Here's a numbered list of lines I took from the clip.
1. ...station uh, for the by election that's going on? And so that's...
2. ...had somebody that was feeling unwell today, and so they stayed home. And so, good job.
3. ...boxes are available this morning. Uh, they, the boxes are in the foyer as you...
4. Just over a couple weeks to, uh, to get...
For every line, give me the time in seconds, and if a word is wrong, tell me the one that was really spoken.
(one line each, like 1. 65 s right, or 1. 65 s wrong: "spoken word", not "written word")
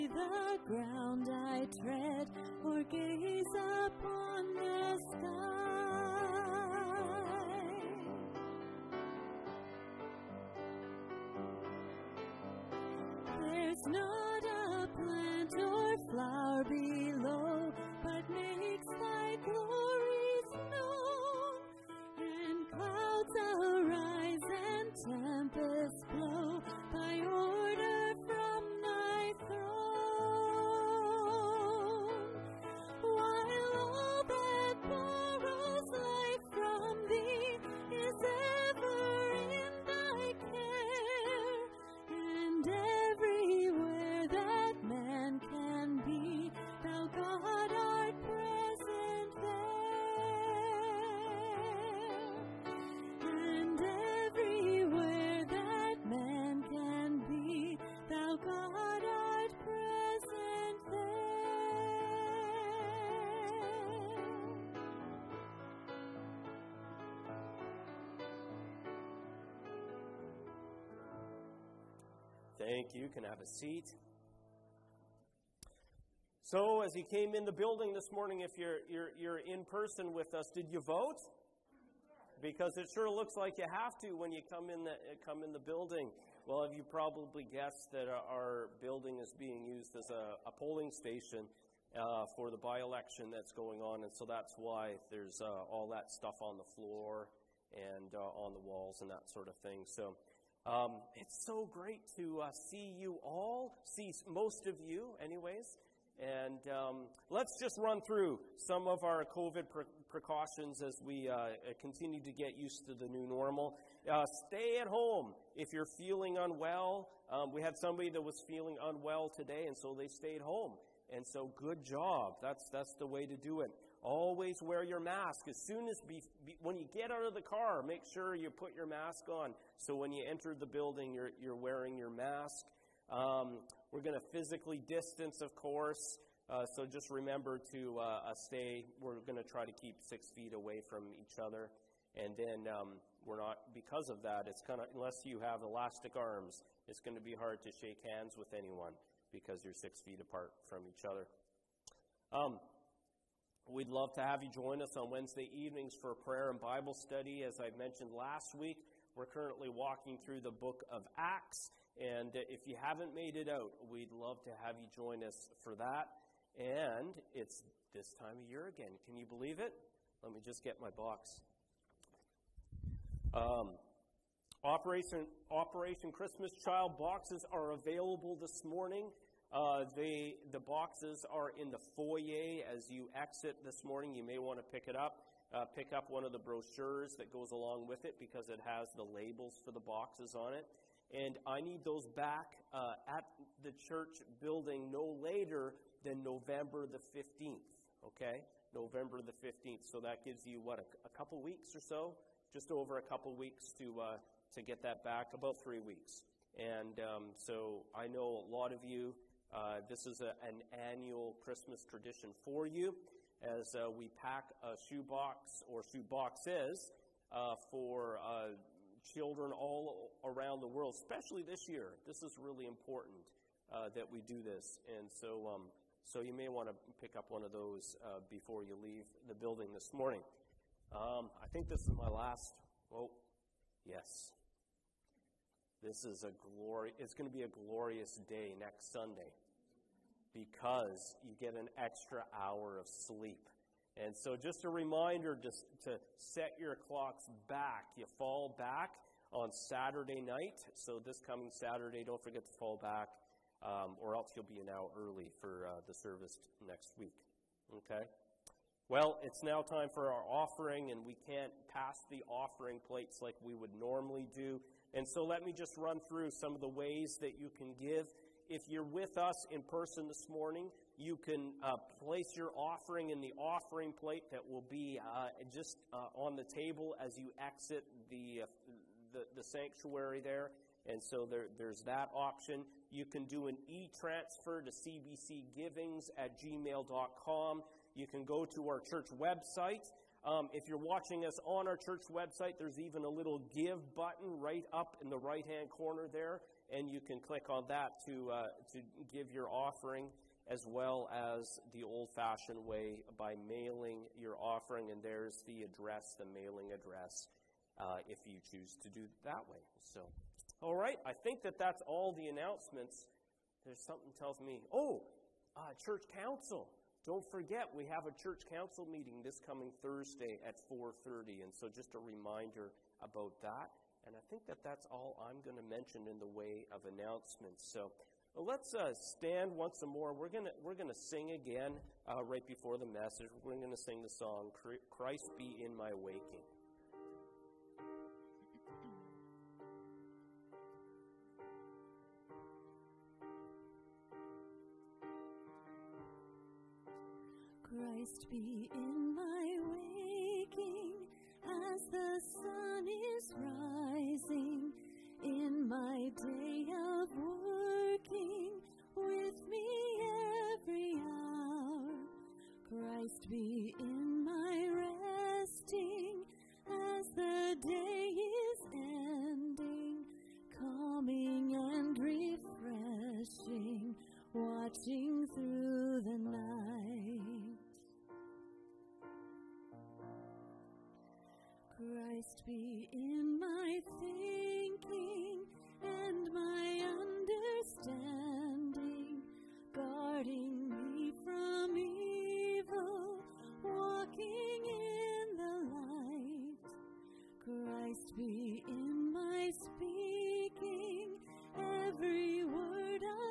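1. 90 s right
2. 117 s right
3. 176 s right
4. 202 s right.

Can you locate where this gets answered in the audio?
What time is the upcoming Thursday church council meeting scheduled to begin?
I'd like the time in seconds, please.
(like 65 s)
320 s.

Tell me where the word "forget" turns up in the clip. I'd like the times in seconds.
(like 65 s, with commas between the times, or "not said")
252 s, 317 s.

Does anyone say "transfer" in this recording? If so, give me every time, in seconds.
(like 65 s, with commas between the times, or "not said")
283 s.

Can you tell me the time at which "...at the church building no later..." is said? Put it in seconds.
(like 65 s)
193 s.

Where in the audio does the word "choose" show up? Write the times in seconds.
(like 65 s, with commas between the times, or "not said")
308 s.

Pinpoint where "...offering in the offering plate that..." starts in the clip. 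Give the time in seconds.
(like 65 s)
272 s.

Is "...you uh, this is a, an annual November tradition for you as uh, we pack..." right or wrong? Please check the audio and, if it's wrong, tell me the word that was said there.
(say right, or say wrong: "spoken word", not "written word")
wrong: "Christmas", not "November".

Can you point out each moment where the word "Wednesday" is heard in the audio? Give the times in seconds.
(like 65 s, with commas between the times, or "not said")
155 s.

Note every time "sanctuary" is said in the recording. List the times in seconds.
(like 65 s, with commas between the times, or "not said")
279 s.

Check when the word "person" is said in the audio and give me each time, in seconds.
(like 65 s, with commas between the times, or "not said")
79 s, 269 s.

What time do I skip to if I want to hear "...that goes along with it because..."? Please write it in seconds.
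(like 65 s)
187 s.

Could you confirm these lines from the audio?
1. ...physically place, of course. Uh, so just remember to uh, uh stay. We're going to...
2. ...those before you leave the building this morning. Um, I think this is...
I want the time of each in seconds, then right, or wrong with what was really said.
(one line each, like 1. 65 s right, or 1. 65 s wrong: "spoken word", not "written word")
1. 134 s wrong: "distance", not "place"
2. 227 s right.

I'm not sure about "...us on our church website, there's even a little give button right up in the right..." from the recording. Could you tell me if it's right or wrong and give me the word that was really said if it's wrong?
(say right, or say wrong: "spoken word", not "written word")
right.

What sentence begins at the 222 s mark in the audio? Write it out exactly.
This is really important uh, that we do this.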